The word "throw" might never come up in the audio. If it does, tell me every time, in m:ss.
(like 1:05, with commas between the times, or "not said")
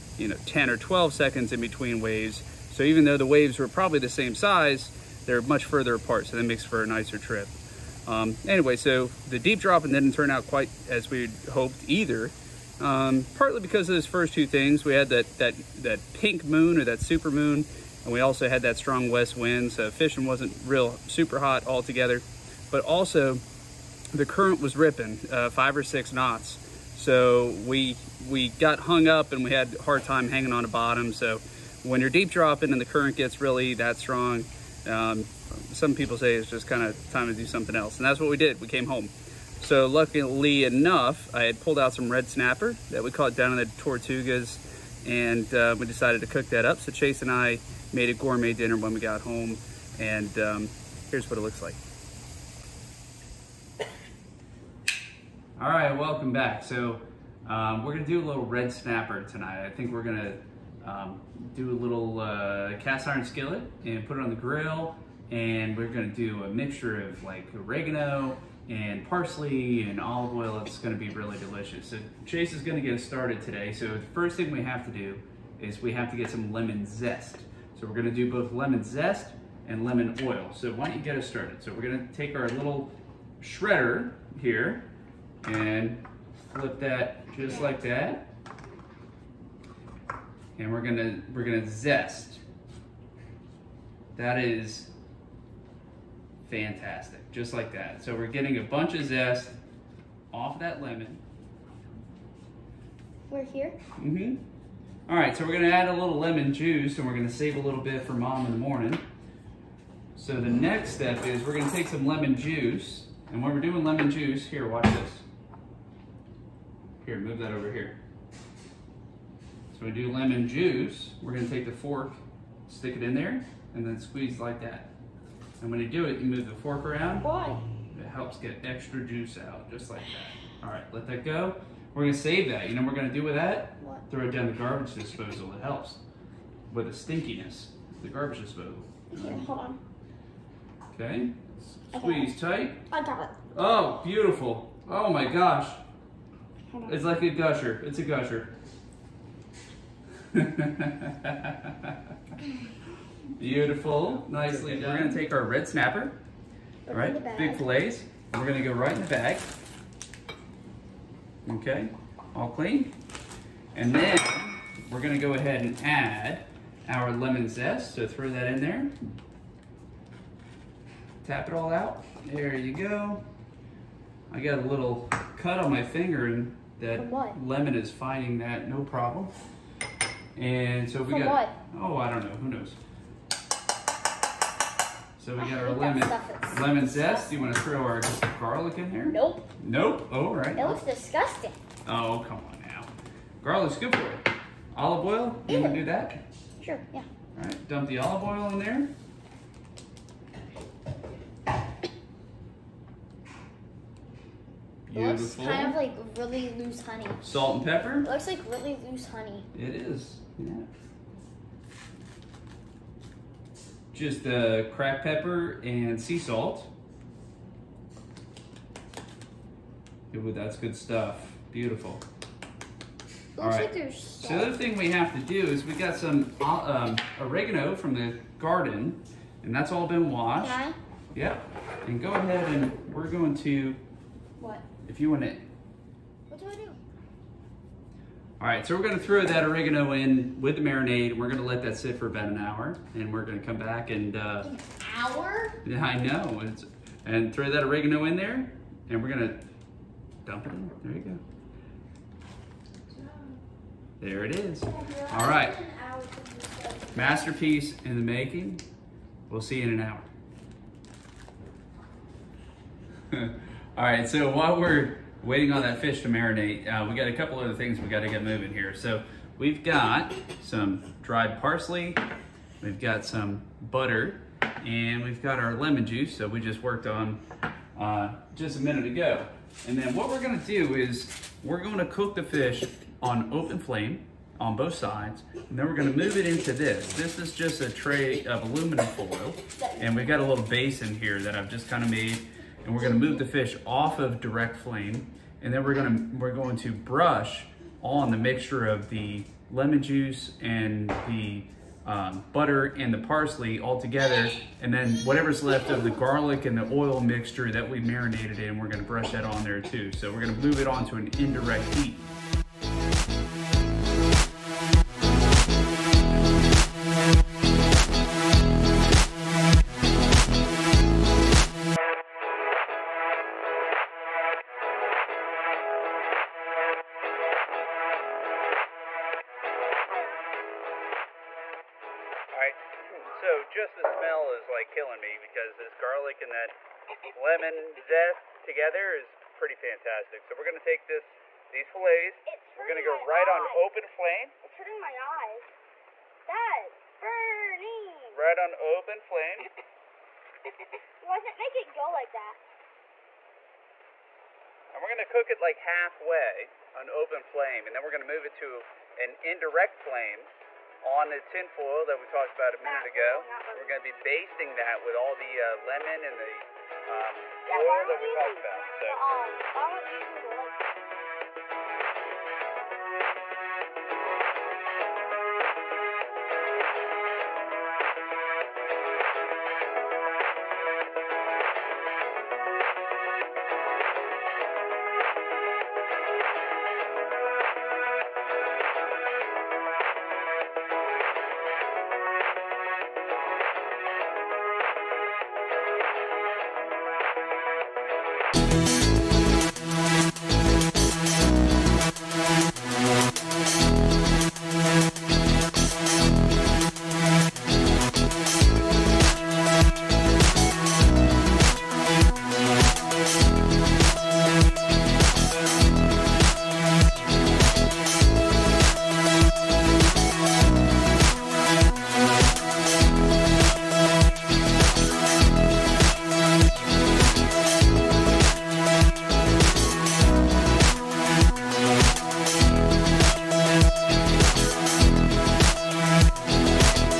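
2:14, 2:48, 3:07, 3:58, 4:07.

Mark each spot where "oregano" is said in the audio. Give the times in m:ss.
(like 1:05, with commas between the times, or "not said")
1:07, 3:47, 3:59, 4:07.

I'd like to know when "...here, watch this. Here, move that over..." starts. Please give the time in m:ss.
1:54.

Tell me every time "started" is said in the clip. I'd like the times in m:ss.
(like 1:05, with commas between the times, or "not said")
1:13, 1:21.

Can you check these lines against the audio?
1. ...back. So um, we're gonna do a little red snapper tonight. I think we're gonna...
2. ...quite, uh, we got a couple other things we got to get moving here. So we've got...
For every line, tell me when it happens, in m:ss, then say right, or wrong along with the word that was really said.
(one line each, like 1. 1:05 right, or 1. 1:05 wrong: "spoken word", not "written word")
1. 0:56 right
2. 4:26 wrong: "marinate", not "quite".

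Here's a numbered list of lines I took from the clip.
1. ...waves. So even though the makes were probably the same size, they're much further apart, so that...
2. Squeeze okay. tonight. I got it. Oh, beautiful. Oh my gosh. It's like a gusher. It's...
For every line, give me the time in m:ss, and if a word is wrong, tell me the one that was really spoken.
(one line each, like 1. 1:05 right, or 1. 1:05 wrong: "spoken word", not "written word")
1. 0:01 wrong: "waves", not "makes"
2. 2:21 wrong: "tight", not "tonight".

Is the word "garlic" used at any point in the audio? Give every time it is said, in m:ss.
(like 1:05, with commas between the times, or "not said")
3:08, 3:13, 5:05, 5:35.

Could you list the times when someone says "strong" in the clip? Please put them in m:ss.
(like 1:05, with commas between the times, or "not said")
0:18, 0:33.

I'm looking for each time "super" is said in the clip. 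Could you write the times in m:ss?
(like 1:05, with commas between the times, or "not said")
0:16, 0:21.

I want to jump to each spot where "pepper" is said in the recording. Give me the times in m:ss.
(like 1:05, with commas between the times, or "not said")
3:27, 3:35.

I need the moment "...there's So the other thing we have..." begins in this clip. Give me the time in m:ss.
3:43.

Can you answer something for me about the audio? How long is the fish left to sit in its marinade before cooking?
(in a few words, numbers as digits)
1 hour.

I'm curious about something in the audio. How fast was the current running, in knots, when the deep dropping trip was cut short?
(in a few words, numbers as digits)
5 or 6 knots.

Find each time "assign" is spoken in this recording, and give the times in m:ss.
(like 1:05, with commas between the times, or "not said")
not said.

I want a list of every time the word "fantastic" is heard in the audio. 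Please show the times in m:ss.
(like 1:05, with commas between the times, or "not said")
1:36, 5:39.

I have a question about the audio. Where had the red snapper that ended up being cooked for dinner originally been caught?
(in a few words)
Tortugas.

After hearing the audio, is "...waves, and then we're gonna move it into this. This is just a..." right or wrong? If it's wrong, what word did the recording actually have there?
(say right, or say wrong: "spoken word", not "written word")
wrong: "sides", not "waves".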